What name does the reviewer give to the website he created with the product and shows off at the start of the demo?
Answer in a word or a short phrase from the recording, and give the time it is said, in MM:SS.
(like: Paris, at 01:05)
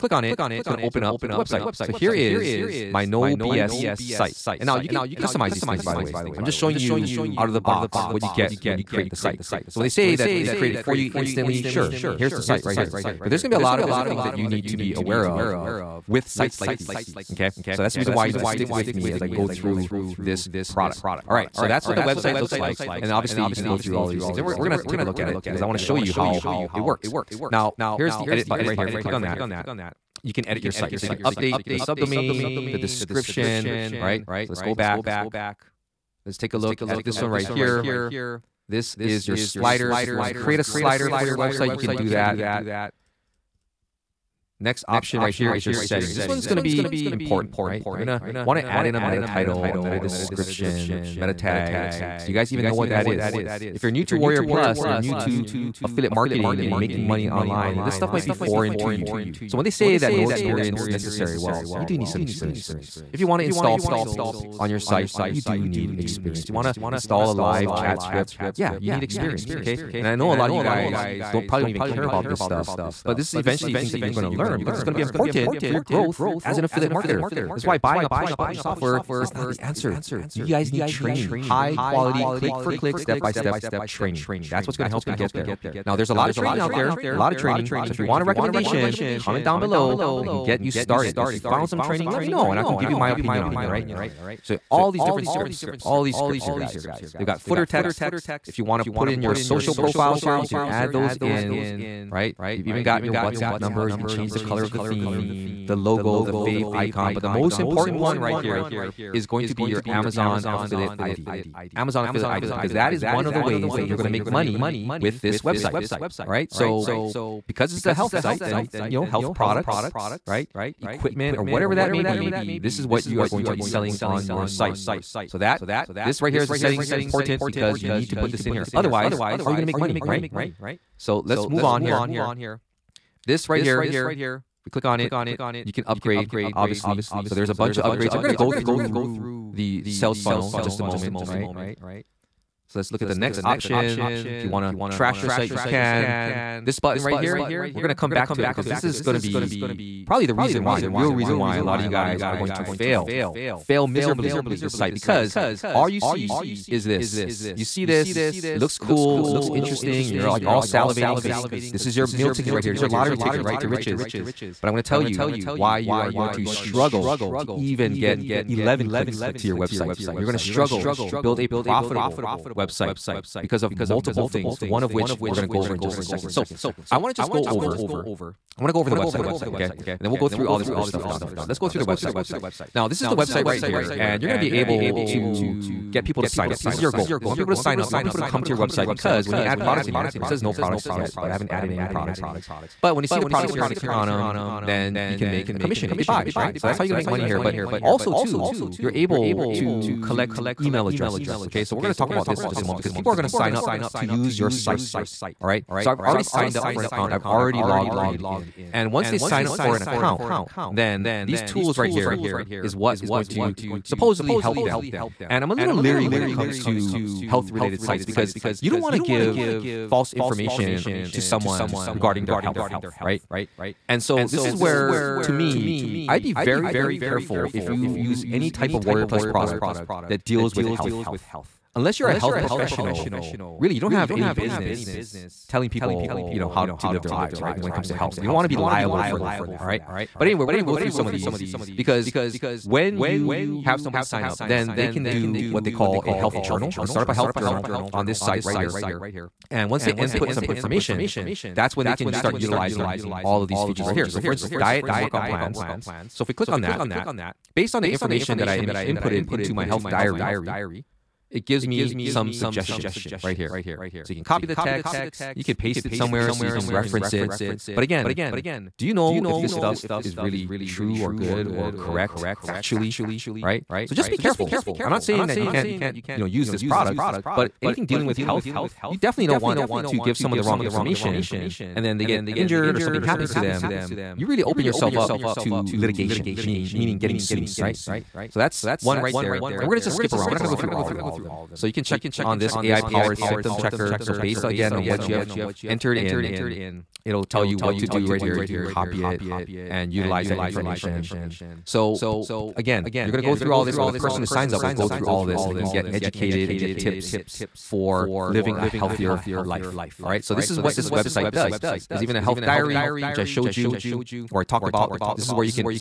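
No BS site, at 00:03.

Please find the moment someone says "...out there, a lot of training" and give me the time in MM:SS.
01:26.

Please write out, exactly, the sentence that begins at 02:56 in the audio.
So, I want to just go over I want to go over the website here, okay?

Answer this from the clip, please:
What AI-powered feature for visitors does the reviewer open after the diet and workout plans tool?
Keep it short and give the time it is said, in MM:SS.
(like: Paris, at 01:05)
Symptom checker, at 04:53.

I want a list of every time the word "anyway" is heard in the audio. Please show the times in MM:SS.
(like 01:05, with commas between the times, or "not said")
04:00.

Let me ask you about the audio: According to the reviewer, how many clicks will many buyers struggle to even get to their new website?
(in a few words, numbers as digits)
11.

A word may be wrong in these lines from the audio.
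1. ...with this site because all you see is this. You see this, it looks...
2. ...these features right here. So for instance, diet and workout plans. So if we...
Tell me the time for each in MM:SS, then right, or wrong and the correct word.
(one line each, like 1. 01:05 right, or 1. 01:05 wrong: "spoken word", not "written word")
1. 02:34 right
2. 04:13 right.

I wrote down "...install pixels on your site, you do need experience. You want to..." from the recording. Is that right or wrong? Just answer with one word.
right.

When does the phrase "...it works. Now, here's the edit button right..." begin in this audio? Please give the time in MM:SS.
00:26.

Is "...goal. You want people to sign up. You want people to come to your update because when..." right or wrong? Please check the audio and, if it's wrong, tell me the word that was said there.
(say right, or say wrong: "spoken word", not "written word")
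wrong: "website", not "update".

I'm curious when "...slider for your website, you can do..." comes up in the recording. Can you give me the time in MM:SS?
00:40.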